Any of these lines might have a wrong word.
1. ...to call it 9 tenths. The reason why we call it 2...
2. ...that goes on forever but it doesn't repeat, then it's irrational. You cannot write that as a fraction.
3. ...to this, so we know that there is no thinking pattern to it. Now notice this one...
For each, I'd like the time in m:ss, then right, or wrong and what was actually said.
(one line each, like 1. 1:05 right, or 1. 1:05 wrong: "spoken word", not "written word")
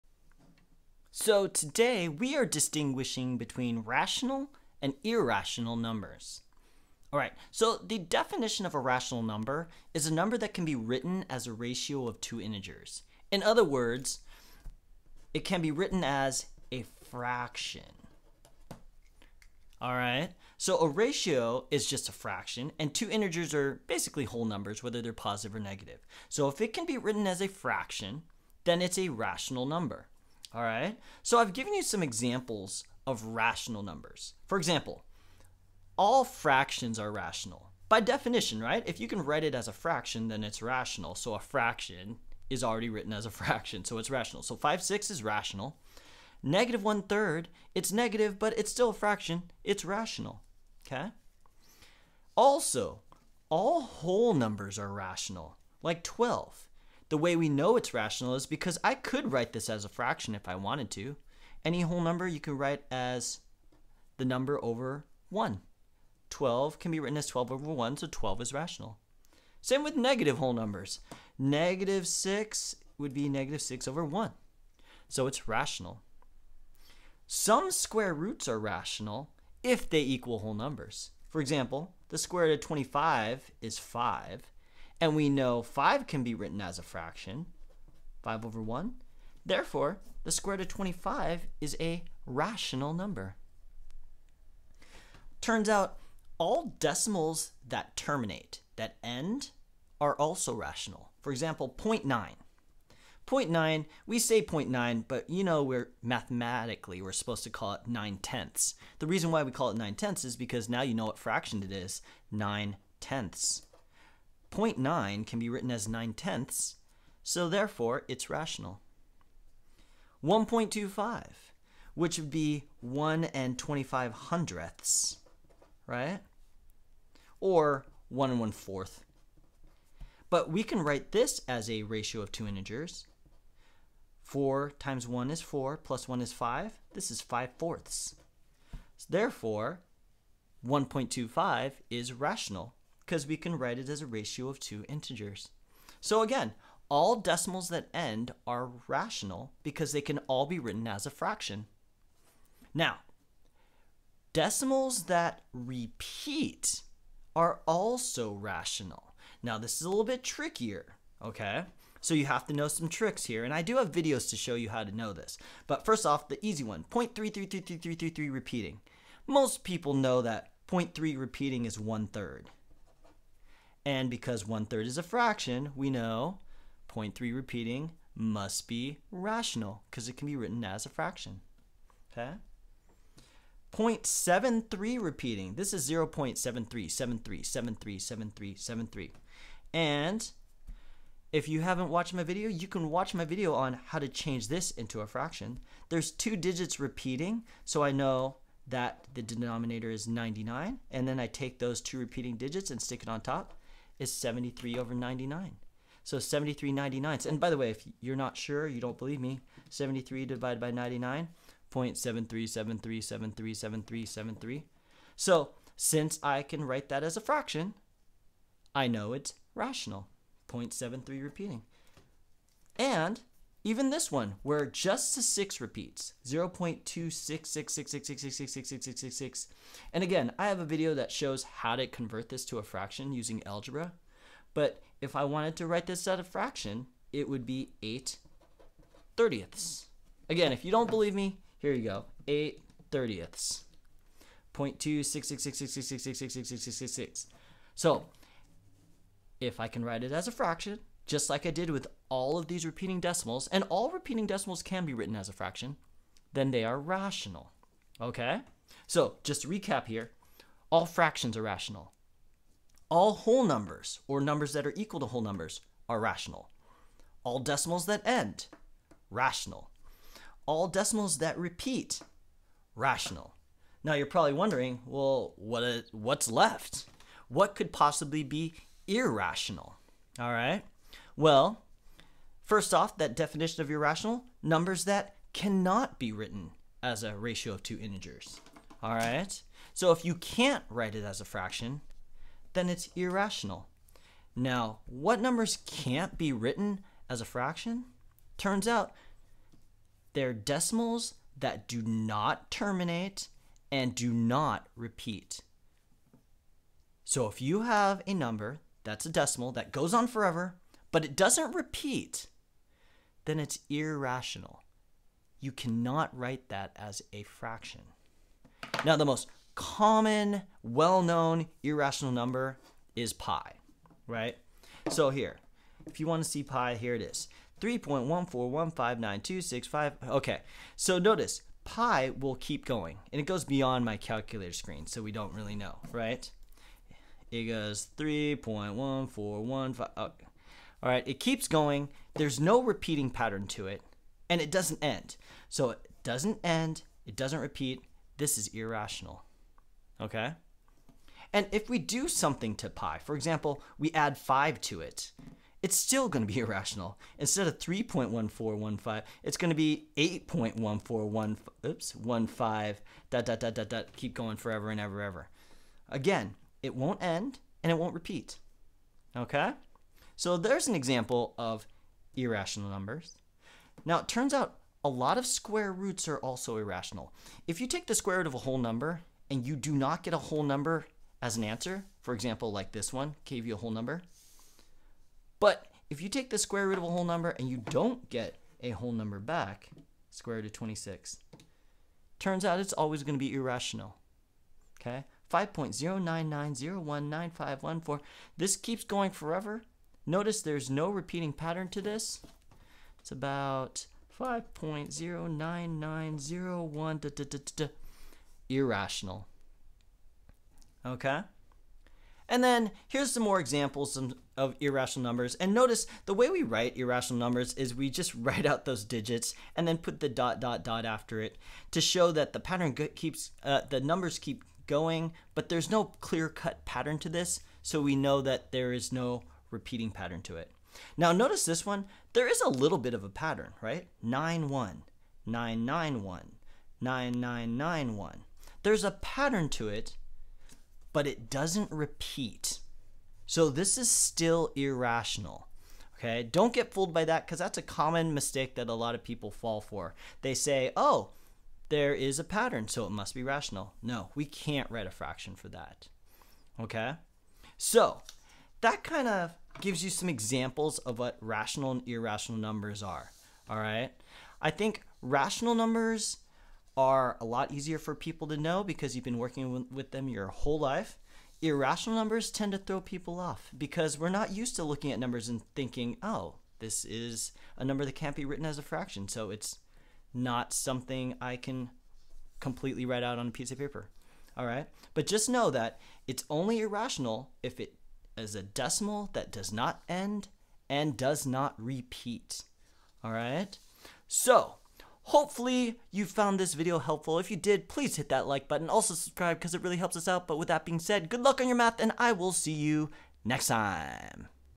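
1. 1:47 wrong: "9", not "2"
2. 5:09 right
3. 7:06 wrong: "repeating", not "thinking".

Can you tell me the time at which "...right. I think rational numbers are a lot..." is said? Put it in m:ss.
7:43.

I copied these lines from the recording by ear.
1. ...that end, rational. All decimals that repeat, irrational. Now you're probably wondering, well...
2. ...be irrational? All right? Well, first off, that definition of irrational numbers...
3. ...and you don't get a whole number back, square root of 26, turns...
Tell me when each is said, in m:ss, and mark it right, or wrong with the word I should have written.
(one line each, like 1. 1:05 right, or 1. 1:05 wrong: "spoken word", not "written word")
1. 4:27 wrong: "rational", not "irrational"
2. 4:38 right
3. 6:27 right.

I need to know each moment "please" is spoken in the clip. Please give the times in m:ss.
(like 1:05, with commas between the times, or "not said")
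8:17.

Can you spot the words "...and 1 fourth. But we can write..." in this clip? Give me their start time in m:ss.
2:08.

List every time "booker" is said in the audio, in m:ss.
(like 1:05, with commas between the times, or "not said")
not said.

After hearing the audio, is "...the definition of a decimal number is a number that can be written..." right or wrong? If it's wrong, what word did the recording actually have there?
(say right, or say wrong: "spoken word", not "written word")
wrong: "rational", not "decimal".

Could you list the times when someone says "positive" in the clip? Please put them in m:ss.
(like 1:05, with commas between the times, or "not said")
0:25.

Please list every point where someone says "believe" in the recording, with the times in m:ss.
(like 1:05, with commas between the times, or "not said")
3:28, 4:00.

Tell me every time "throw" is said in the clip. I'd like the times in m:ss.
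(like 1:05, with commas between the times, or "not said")
7:52.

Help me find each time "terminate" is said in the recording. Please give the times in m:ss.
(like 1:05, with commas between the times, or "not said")
1:37, 5:02.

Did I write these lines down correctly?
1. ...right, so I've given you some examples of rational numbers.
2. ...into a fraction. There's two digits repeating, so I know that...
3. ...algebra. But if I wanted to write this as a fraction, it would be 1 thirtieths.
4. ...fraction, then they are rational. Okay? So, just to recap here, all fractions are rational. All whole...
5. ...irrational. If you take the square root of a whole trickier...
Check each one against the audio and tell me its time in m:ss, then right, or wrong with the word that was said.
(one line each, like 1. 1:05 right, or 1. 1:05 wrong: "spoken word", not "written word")
1. 0:30 right
2. 3:14 right
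3. 3:53 wrong: "8", not "1"
4. 4:15 right
5. 6:16 wrong: "number", not "trickier".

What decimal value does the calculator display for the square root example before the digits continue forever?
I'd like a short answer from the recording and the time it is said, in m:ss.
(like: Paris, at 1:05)
5.099019514, at 6:35.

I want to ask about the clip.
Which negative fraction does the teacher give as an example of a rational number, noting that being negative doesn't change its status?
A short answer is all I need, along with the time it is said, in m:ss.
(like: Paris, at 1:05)
Negative 1/3, at 0:46.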